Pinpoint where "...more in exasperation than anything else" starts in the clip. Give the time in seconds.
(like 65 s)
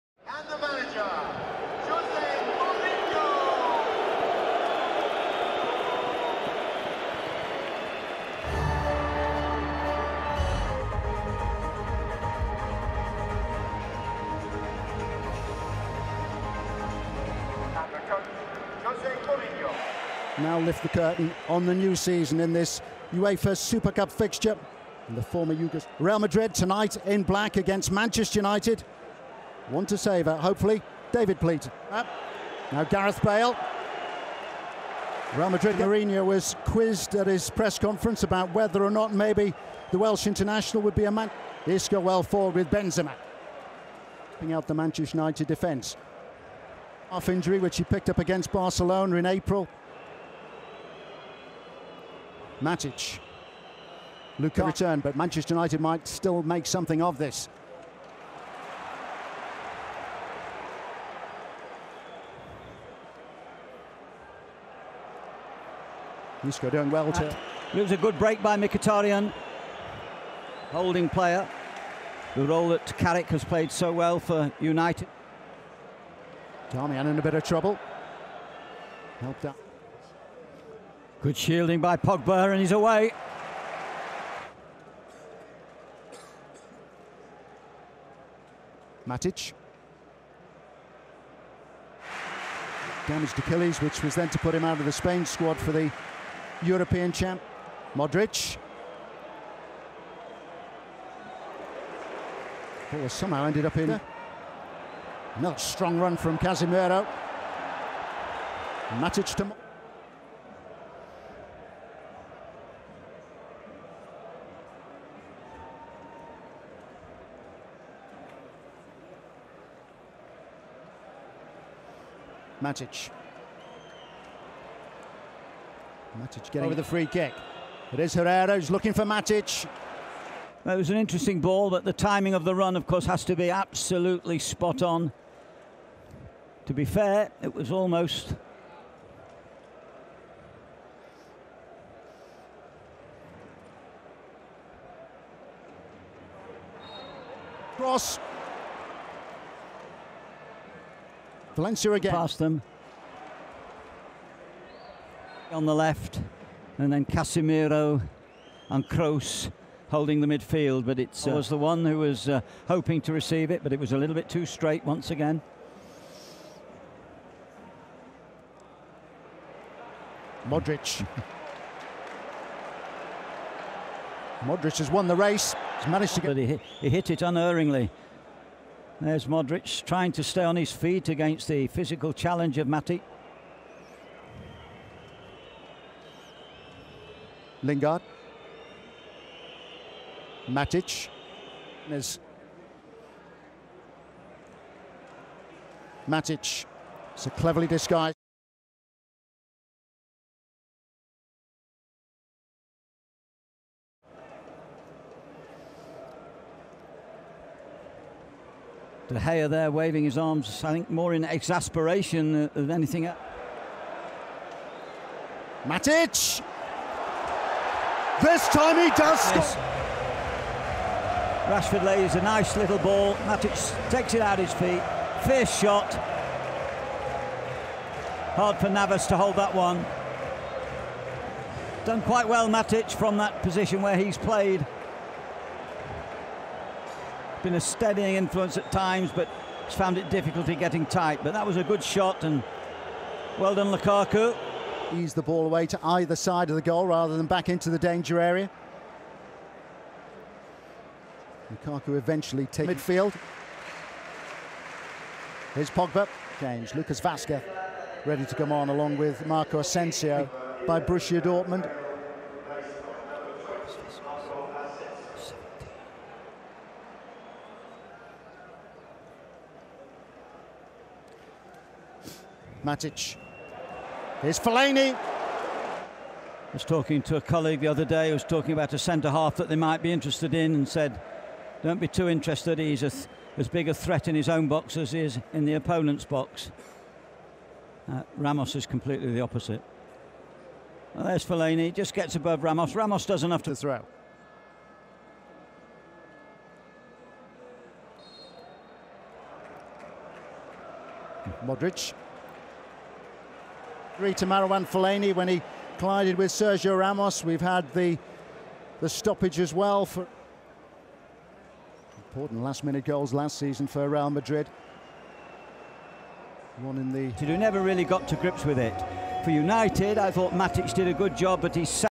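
210 s.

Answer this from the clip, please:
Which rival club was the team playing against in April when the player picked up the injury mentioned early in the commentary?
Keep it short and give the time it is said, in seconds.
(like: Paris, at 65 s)
Barcelona, at 48 s.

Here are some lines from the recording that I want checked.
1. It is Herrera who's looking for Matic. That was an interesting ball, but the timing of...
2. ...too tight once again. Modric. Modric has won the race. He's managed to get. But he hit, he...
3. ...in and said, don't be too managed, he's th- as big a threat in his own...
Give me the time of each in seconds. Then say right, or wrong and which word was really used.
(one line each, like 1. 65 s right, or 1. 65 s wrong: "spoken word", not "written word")
1. 127 s right
2. 164 s wrong: "straight", not "tight"
3. 280 s wrong: "interested", not "managed".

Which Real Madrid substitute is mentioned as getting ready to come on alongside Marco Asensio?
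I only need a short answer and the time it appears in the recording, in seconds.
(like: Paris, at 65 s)
Lucas Vasquez, at 256 s.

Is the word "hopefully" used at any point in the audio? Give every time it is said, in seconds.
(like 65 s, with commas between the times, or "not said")
30 s.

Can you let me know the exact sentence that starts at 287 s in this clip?
Uh, Ramos is completely the opposite.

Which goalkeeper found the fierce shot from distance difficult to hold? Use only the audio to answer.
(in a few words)
Navas.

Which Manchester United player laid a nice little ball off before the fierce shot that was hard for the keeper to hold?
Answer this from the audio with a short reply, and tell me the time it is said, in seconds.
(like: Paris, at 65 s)
Rashford, at 221 s.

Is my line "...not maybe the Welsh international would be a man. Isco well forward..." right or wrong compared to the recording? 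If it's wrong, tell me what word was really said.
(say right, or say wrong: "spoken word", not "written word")
right.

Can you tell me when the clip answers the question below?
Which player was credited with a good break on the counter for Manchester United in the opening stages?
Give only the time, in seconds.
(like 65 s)
68 s.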